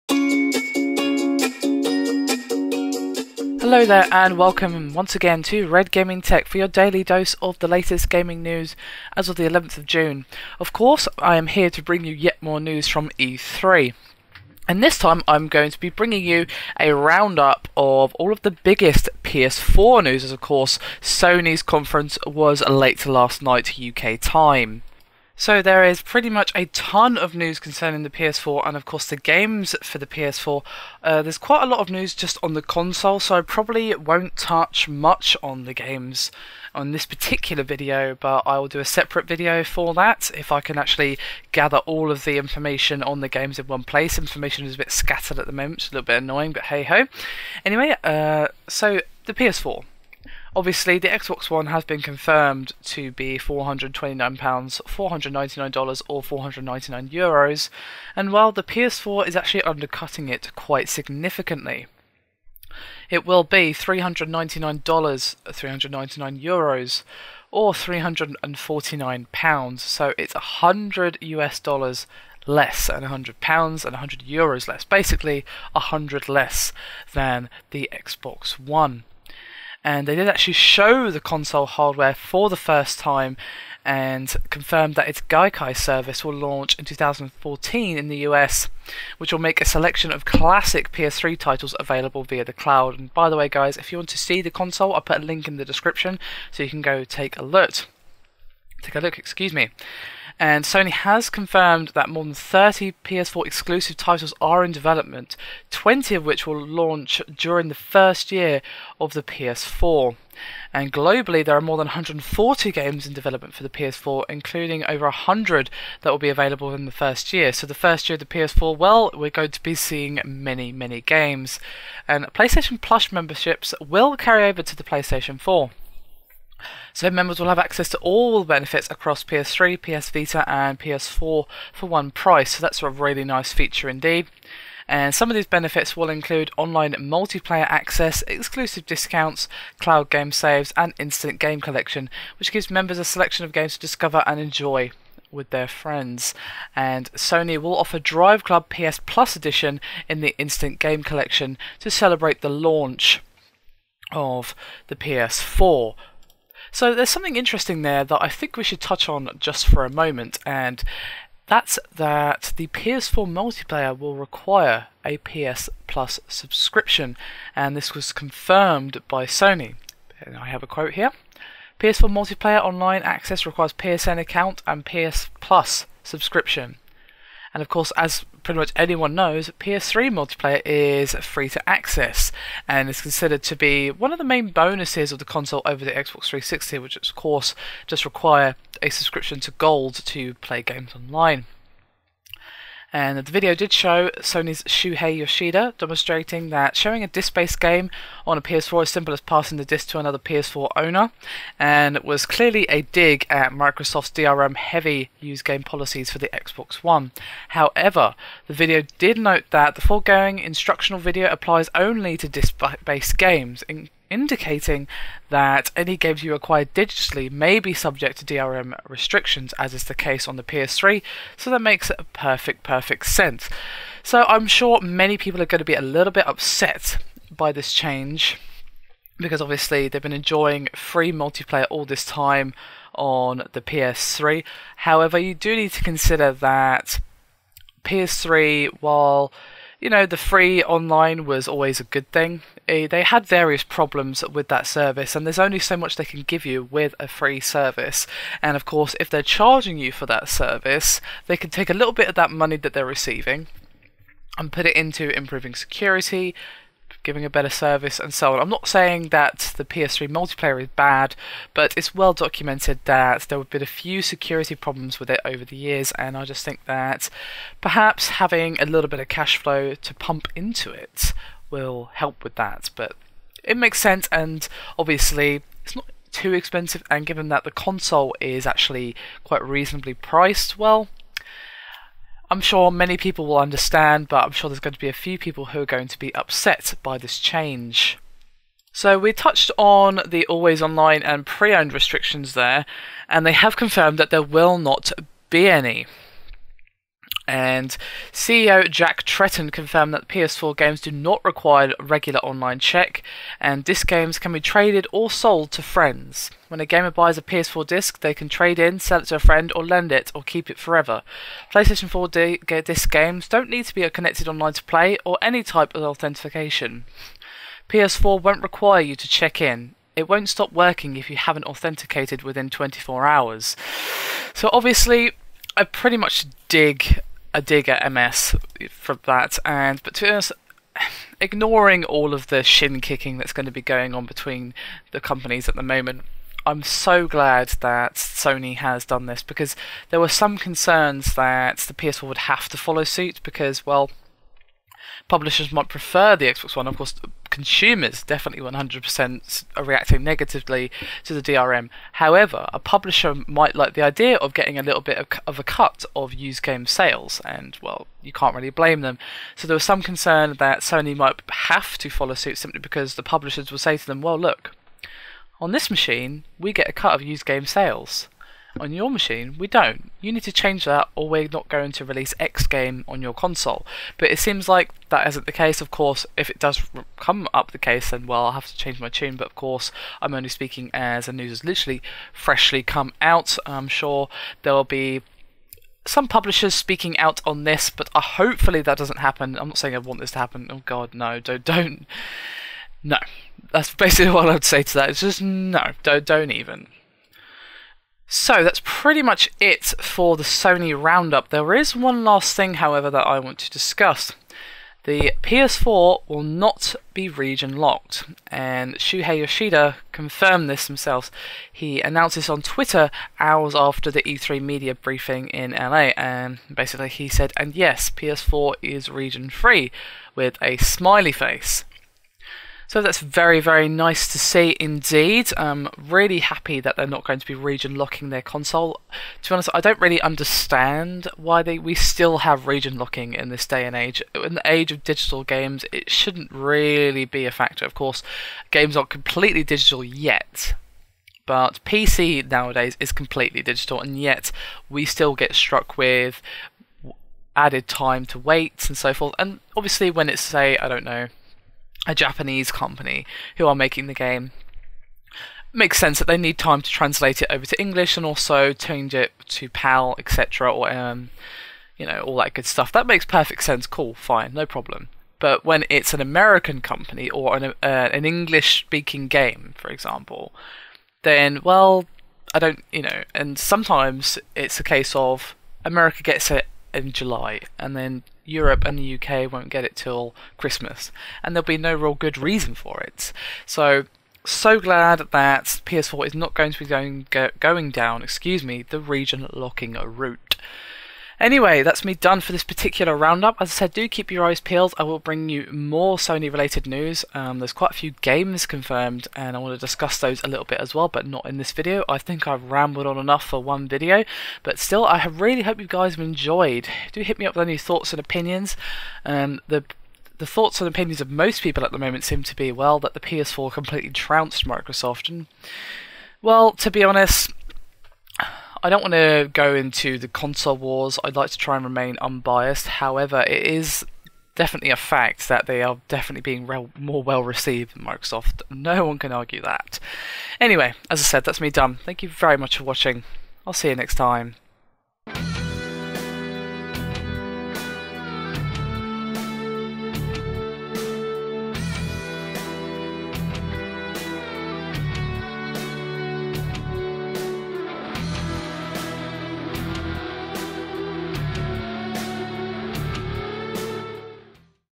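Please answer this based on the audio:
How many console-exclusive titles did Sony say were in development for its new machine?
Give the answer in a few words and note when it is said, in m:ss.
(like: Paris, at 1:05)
more than 30, at 1:42.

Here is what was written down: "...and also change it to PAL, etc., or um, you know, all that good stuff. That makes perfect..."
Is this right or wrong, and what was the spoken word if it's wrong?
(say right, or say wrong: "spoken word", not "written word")
right.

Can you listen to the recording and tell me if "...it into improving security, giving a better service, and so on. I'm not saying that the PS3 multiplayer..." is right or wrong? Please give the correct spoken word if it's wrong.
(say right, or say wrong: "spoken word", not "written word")
right.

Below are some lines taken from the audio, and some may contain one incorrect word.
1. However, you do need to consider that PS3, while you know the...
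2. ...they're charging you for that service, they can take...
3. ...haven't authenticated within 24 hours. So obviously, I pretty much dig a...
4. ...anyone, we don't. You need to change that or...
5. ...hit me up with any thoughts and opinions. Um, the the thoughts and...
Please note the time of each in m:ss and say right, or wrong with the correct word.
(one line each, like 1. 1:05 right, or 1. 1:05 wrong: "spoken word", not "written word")
1. 3:54 right
2. 4:09 right
3. 5:21 right
4. 6:08 wrong: "machine", not "anyone"
5. 8:27 right.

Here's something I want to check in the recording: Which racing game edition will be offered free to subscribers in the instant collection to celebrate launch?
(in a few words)
Drive Club PS Plus Edition.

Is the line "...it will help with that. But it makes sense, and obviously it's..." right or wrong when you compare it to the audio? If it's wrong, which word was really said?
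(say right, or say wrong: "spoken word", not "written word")
right.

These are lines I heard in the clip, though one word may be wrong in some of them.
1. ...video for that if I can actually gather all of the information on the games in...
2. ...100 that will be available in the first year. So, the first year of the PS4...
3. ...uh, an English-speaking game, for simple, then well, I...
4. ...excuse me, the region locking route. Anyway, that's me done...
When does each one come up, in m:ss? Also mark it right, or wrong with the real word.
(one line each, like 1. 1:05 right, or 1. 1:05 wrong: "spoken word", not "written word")
1. 0:39 right
2. 1:55 right
3. 7:47 wrong: "example", not "simple"
4. 8:08 right.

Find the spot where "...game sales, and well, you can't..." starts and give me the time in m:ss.
5:56.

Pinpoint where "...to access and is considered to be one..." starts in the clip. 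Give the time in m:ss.
3:01.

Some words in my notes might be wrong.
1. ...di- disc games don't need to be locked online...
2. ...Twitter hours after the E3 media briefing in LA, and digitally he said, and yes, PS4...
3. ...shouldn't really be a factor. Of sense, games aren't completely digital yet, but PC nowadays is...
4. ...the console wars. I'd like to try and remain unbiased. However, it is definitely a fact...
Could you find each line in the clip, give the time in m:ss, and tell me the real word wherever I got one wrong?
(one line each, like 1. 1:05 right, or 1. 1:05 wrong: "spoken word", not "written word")
1. 5:12 wrong: "connected", not "locked"
2. 6:52 wrong: "basically", not "digitally"
3. 7:15 wrong: "course", not "sense"
4. 8:39 right.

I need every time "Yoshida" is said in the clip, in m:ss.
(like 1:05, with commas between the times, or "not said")
3:15, 6:49.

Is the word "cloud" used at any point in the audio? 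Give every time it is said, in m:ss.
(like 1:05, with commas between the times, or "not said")
1:32, 2:19.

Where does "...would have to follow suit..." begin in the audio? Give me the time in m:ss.
5:42.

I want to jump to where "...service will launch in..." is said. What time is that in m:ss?
1:25.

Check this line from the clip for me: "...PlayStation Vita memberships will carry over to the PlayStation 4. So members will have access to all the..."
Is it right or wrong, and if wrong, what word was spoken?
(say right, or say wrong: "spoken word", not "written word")
wrong: "Plus", not "Vita".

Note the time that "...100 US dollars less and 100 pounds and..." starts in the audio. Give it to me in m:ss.
1:10.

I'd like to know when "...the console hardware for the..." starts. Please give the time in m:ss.
1:21.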